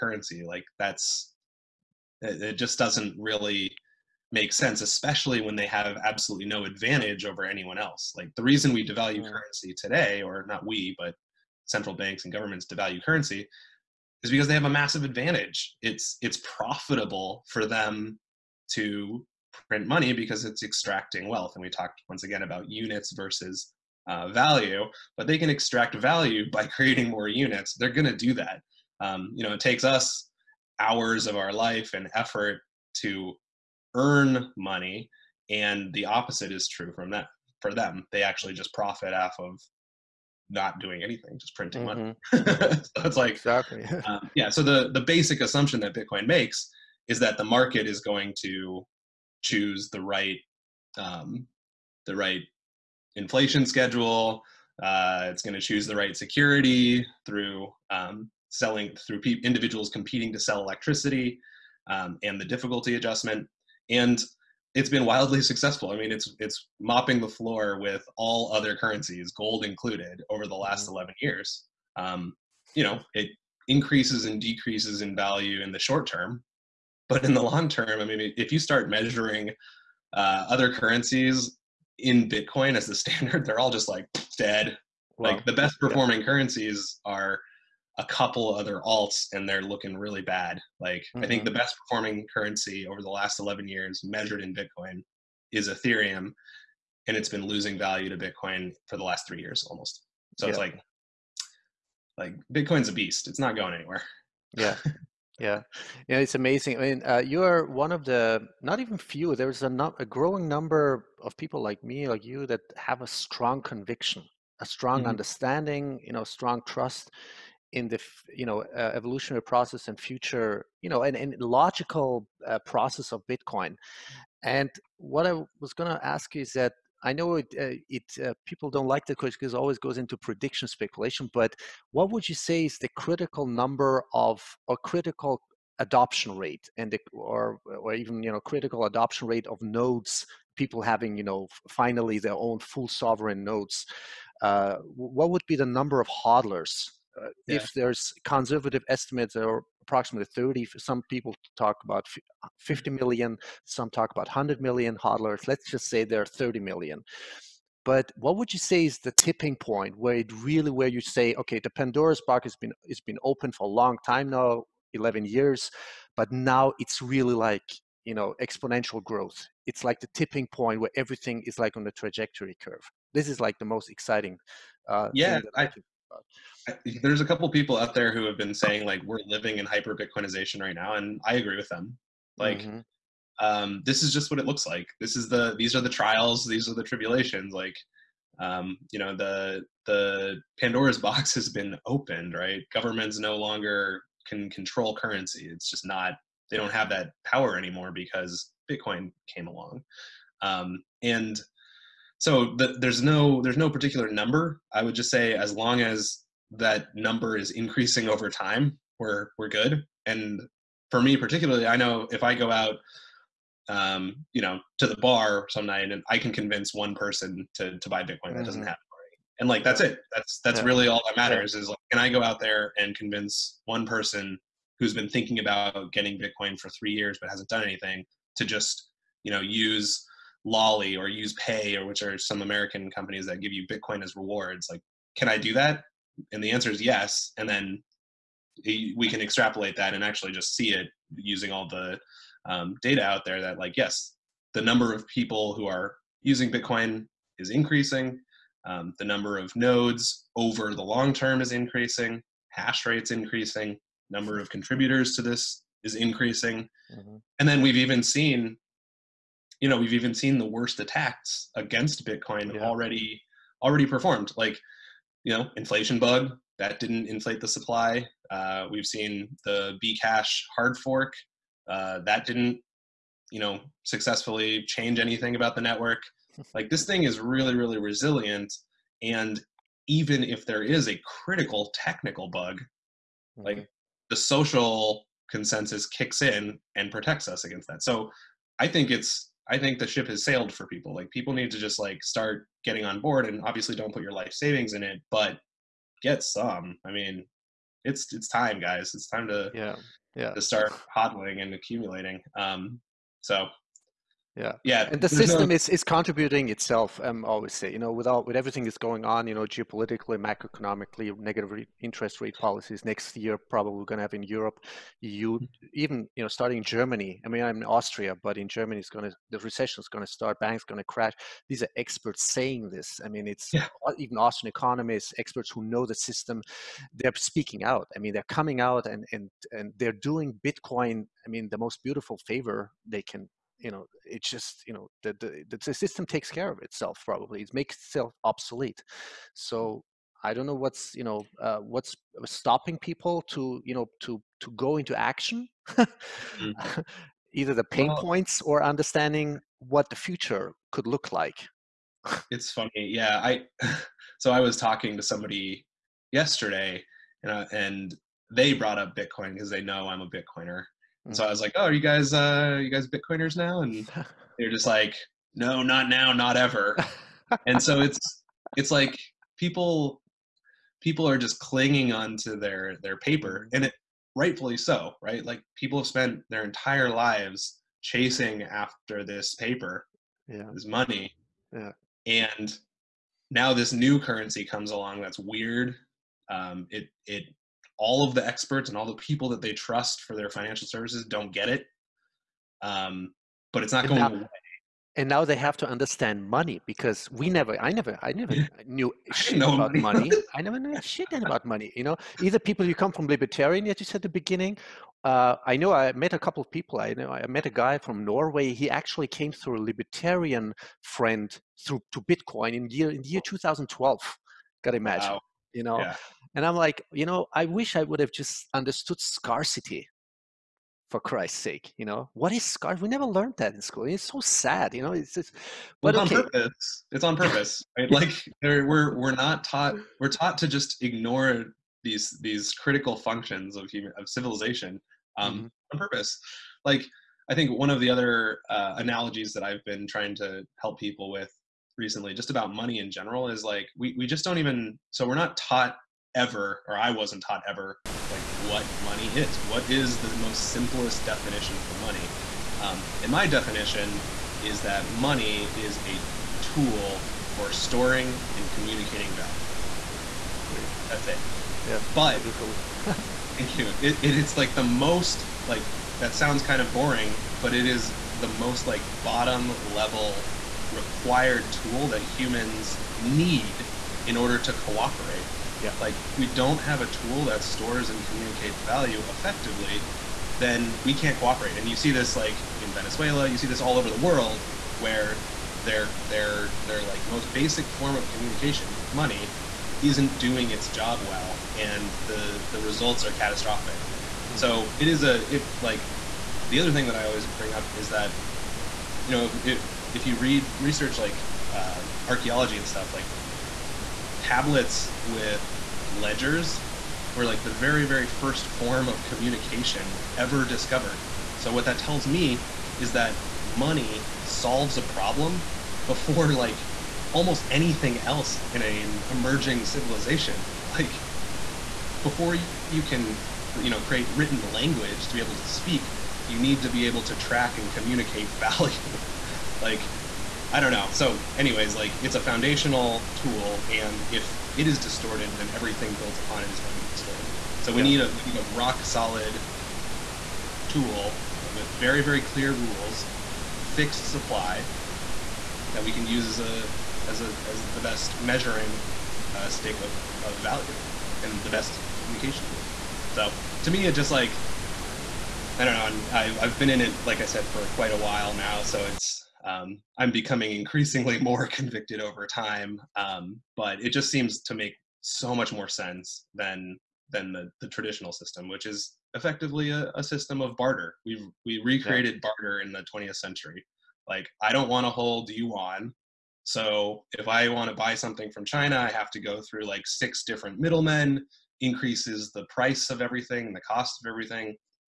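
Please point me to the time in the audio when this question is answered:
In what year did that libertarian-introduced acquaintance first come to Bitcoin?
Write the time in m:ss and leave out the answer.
6:53.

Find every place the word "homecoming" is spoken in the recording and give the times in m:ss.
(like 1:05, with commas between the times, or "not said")
not said.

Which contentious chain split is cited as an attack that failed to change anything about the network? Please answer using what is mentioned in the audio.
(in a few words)
bcash hard fork.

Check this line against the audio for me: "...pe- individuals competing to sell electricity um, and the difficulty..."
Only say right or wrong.
right.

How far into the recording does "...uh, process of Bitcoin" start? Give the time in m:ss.
2:02.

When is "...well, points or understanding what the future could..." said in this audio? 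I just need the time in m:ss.
5:47.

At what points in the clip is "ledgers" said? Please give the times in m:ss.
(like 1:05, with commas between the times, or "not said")
8:25.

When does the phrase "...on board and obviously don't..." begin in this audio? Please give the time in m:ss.
4:52.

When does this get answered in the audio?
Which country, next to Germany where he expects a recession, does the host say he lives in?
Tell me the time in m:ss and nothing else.
5:17.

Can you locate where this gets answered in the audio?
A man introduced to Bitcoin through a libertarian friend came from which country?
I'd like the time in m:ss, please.
6:48.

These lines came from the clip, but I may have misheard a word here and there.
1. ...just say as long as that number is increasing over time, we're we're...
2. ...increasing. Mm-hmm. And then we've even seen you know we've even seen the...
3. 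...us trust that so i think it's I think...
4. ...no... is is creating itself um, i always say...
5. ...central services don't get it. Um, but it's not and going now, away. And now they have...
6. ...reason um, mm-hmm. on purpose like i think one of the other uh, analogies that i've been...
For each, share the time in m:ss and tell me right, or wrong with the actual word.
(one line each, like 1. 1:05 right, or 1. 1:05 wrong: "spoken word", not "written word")
1. 3:24 right
2. 4:15 right
3. 4:47 wrong: "against", not "trust"
4. 5:05 wrong: "contributing", not "creating"
5. 6:30 wrong: "financial", not "central"
6. 7:14 wrong: "civilization", not "reason".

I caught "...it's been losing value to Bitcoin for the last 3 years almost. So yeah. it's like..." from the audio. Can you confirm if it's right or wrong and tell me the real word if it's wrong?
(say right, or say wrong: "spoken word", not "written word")
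right.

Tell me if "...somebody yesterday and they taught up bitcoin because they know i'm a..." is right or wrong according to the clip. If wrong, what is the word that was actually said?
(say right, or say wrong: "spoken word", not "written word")
wrong: "brought", not "taught".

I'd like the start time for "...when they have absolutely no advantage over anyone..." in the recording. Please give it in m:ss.
0:05.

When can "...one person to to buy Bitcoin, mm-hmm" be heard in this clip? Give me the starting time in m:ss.
3:36.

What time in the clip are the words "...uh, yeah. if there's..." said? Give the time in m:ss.
2:27.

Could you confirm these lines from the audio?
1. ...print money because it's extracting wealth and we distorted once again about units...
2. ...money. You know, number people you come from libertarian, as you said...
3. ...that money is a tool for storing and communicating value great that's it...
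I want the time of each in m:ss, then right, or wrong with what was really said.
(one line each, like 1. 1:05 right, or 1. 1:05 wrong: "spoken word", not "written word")
1. 0:19 wrong: "talked", not "distorted"
2. 6:41 wrong: "either", not "number"
3. 7:34 right.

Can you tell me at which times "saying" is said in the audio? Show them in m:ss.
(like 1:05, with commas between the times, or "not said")
2:58, 5:22.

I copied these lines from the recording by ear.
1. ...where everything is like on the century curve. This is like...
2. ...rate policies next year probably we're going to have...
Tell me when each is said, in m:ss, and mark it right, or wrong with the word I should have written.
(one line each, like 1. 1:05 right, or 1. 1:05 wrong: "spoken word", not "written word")
1. 2:50 wrong: "trajectory", not "century"
2. 5:12 right.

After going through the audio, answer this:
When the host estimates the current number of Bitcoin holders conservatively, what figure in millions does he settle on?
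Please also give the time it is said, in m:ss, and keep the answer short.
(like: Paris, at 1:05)
30 million, at 2:35.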